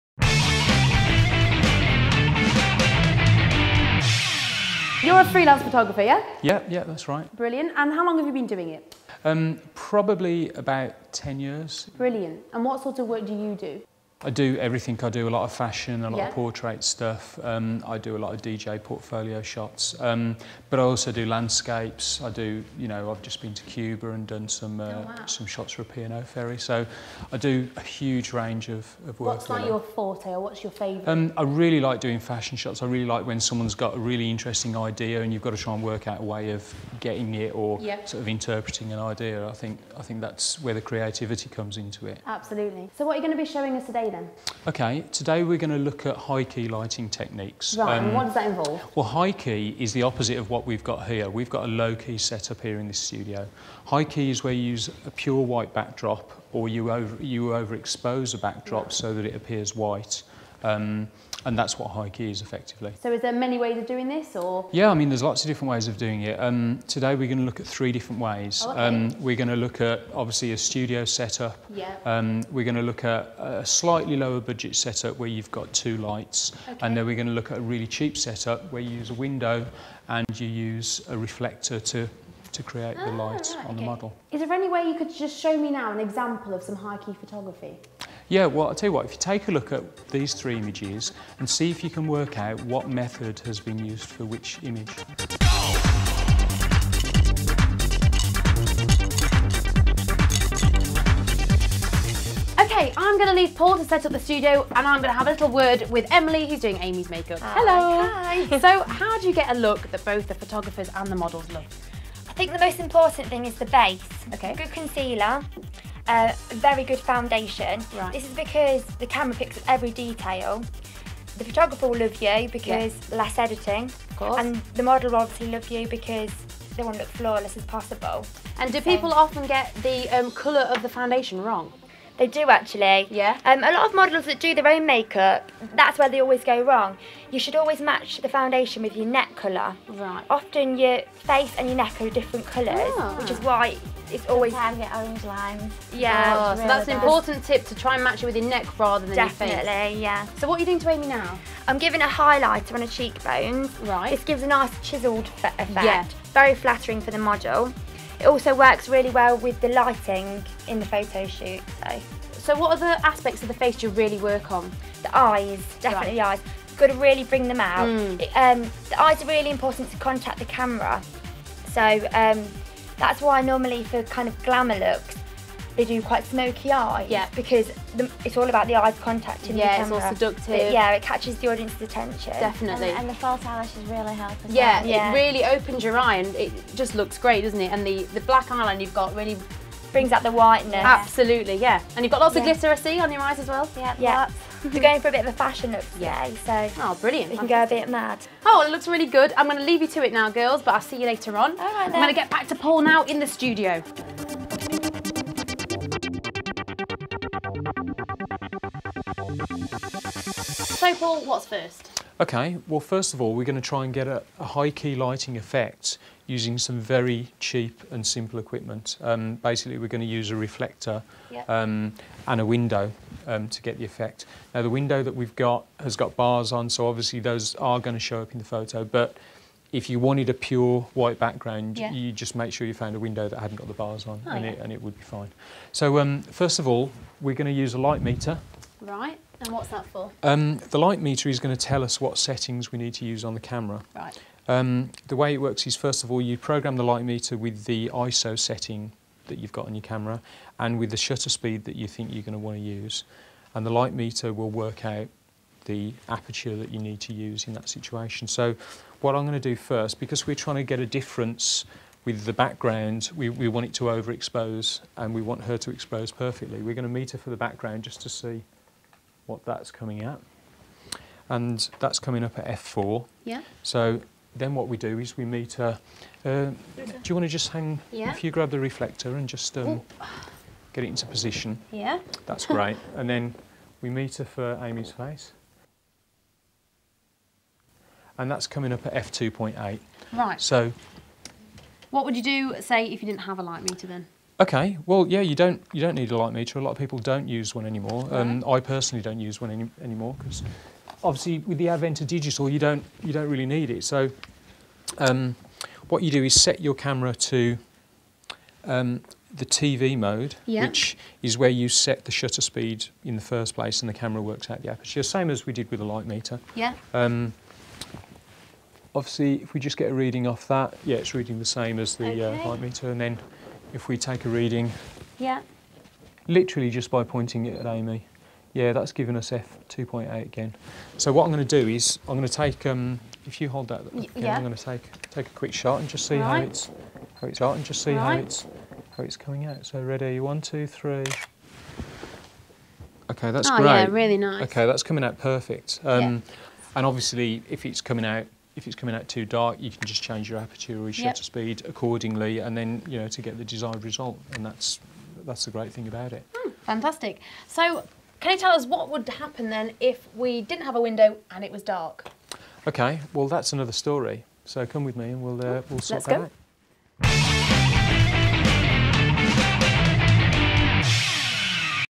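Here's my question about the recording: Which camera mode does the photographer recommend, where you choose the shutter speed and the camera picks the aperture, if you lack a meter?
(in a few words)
TV mode.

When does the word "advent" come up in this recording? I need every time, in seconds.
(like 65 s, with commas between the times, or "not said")
301 s.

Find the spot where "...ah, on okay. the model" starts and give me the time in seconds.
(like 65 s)
83 s.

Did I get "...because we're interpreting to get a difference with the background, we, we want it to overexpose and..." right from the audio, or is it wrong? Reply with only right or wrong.
wrong.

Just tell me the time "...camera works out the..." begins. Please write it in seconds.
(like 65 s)
313 s.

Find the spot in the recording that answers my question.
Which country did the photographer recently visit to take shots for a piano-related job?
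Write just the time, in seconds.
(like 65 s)
23 s.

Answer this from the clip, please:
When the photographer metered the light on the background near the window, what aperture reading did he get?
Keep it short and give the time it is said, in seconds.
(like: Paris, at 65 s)
F4, at 272 s.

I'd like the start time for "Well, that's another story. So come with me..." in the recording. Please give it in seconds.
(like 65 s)
363 s.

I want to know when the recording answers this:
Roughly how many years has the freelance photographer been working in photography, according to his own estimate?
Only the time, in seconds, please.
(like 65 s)
10 s.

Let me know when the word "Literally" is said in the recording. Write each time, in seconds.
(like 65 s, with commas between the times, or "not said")
326 s.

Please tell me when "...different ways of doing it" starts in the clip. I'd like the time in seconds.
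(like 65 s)
65 s.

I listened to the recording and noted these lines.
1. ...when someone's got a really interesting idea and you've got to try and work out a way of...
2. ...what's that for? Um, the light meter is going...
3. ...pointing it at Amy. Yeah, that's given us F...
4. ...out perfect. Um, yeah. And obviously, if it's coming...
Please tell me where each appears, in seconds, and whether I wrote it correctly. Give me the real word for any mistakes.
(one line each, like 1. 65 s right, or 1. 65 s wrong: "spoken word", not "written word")
1. 33 s right
2. 239 s right
3. 327 s right
4. 345 s right.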